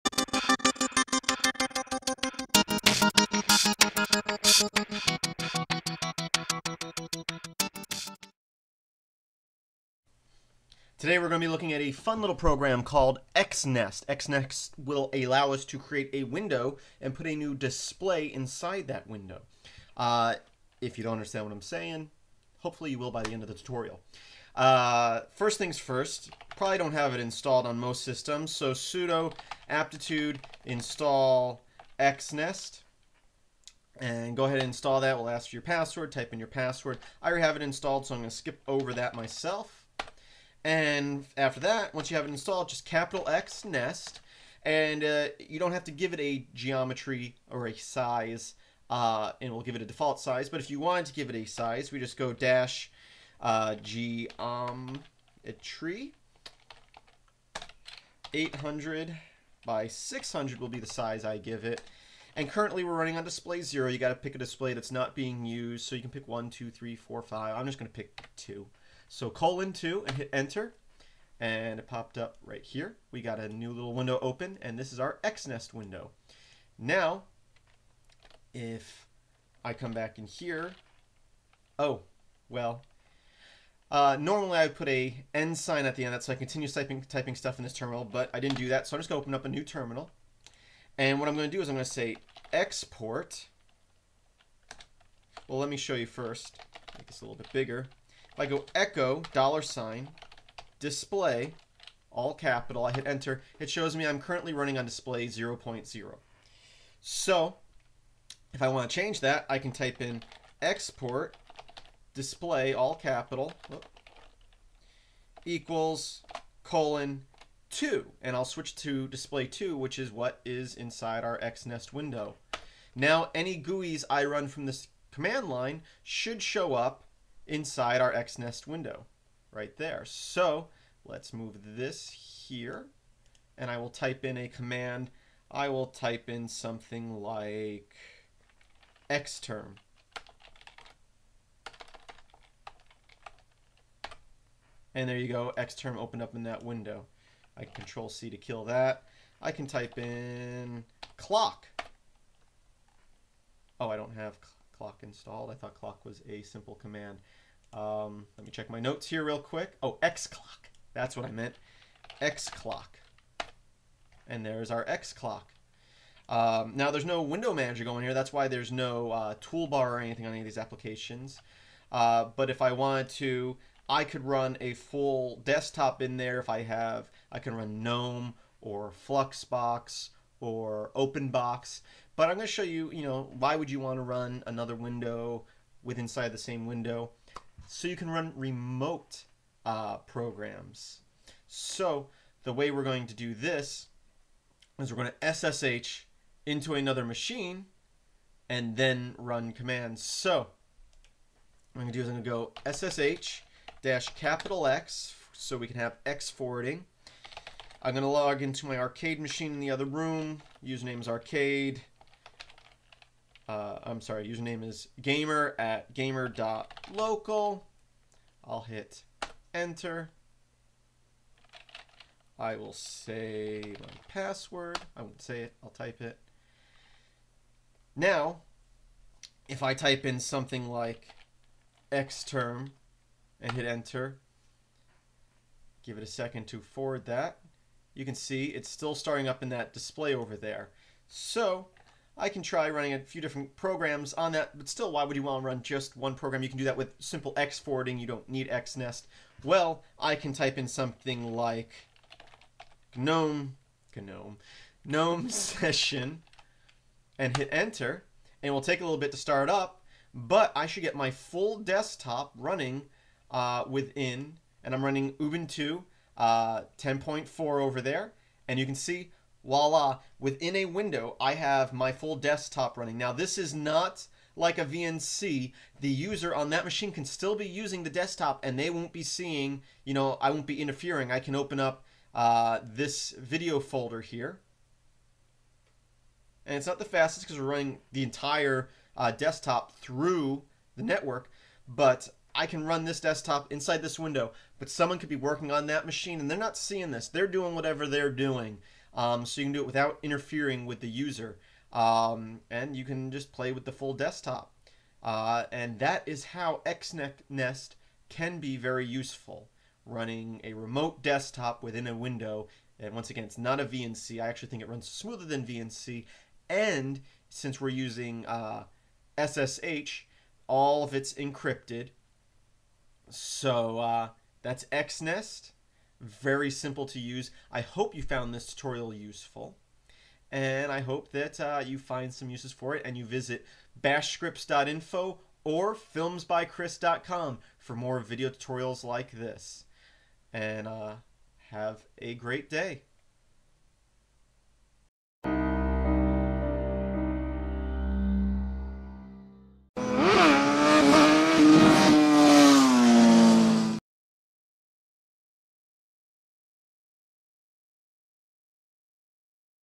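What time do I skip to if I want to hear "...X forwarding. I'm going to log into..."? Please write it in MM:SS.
03:26.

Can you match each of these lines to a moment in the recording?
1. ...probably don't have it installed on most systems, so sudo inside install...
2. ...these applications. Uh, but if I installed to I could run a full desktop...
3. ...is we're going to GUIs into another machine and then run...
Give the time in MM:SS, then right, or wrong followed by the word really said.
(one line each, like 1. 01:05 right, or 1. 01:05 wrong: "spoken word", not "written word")
1. 00:26 wrong: "aptitude", not "inside"
2. 02:50 wrong: "wanted", not "installed"
3. 03:14 wrong: "SSH", not "GUIs".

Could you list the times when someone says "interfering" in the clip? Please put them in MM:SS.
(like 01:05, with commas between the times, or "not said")
04:40, 05:00.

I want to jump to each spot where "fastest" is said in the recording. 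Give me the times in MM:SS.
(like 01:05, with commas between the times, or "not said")
04:46.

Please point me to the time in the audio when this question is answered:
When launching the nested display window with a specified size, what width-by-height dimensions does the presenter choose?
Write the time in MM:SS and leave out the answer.
00:58.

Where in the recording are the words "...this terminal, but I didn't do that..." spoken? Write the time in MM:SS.
01:27.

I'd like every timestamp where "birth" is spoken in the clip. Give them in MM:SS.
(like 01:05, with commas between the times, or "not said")
not said.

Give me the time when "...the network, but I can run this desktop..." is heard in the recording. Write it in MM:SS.
04:50.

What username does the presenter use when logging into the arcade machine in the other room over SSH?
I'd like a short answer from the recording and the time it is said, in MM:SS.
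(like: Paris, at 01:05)
gamer, at 03:34.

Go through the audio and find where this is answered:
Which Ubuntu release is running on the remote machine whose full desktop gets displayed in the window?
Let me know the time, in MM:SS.
04:26.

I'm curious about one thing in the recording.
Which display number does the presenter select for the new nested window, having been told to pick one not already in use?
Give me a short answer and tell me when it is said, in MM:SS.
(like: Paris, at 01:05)
2, at 01:07.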